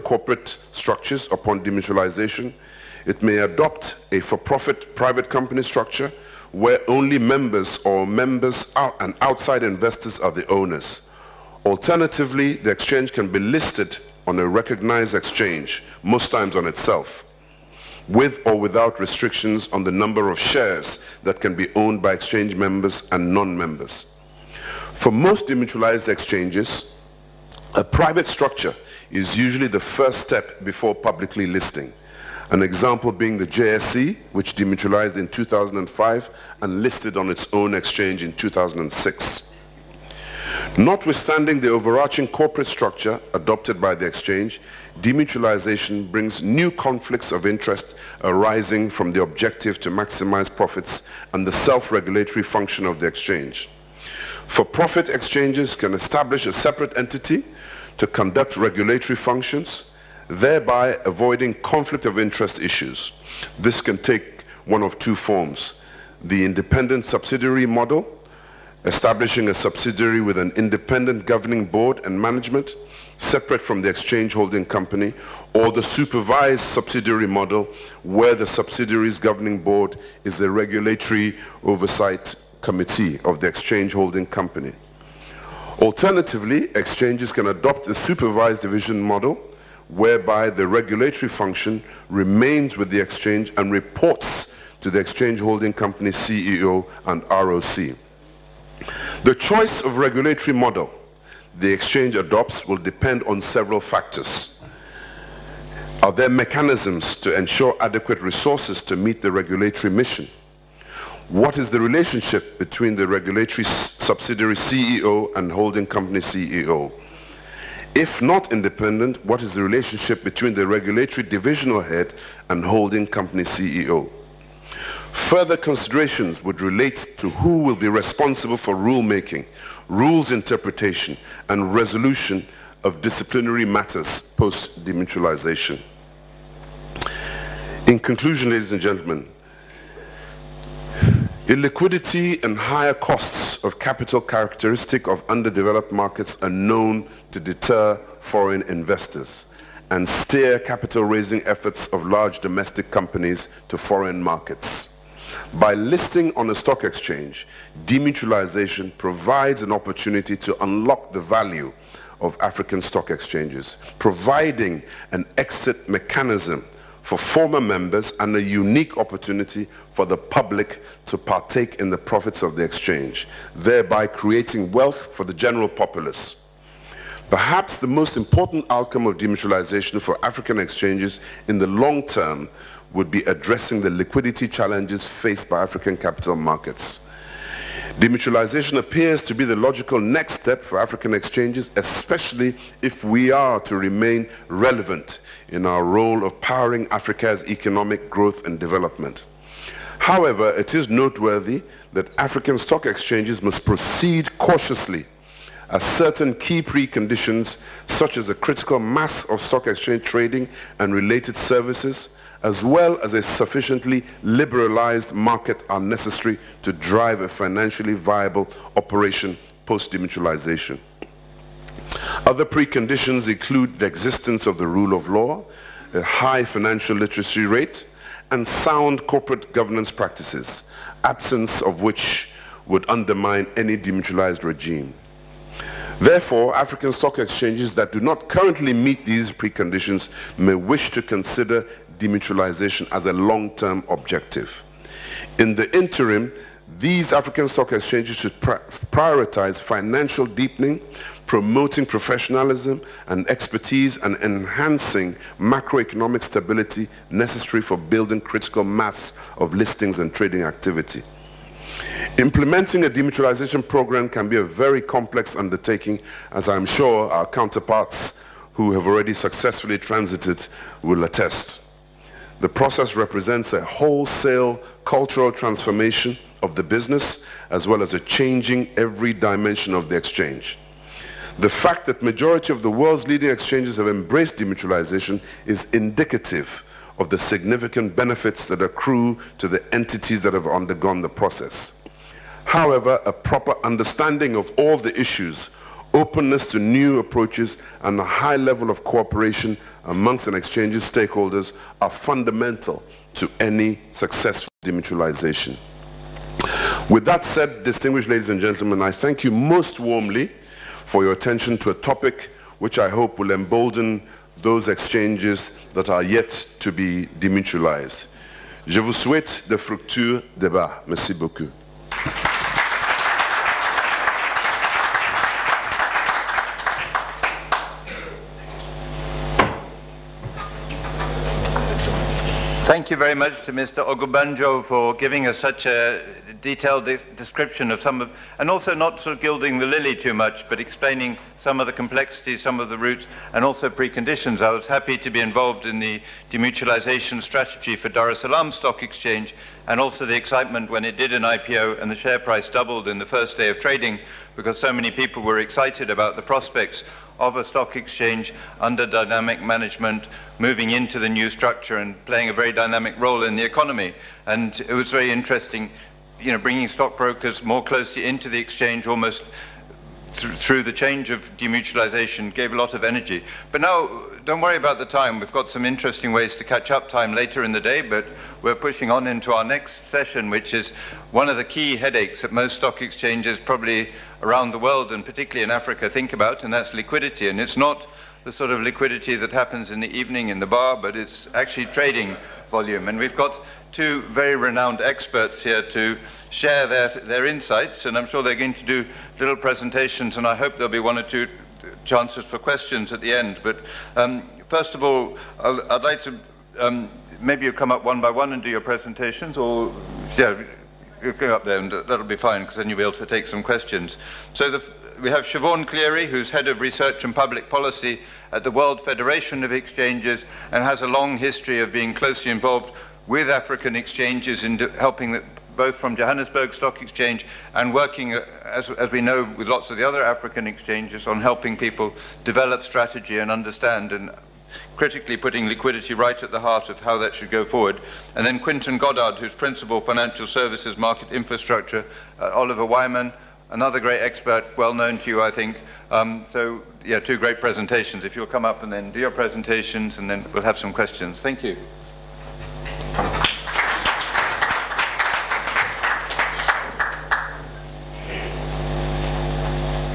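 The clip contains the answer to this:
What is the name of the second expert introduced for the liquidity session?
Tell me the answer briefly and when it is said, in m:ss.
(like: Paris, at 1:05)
Quinton Goddard, at 7:18.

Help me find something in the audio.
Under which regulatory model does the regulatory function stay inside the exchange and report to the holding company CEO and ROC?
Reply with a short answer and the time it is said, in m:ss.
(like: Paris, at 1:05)
Supervised division model, at 1:27.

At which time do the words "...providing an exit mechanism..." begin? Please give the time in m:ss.
2:43.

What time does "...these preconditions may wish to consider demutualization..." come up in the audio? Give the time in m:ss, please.
3:59.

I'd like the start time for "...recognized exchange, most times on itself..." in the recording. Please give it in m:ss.
0:14.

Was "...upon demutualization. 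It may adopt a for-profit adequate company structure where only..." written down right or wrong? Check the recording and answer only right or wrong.
wrong.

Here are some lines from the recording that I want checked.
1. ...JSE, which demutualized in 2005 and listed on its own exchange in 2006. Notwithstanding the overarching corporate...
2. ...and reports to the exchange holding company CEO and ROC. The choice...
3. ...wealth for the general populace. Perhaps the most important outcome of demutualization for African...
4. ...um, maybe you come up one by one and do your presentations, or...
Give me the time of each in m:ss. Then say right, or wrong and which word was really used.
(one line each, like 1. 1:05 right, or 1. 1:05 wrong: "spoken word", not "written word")
1. 0:33 right
2. 1:33 right
3. 2:54 right
4. 6:46 right.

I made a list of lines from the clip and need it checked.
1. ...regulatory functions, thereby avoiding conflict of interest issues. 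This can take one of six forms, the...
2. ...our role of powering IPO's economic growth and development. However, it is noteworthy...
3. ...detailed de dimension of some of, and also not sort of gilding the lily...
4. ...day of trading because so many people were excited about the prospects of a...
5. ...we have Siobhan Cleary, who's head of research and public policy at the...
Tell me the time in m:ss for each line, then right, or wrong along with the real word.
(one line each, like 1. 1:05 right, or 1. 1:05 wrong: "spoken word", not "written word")
1. 0:58 wrong: "two", not "six"
2. 3:15 wrong: "Africa", not "IPO"
3. 5:36 wrong: "description", not "dimension"
4. 5:53 right
5. 6:55 right.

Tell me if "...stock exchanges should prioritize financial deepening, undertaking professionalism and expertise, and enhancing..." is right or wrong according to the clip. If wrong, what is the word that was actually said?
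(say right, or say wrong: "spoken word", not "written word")
wrong: "promoting", not "undertaking".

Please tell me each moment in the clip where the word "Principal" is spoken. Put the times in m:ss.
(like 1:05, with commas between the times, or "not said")
7:19.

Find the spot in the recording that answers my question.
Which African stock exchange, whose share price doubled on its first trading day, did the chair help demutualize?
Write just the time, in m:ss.
5:47.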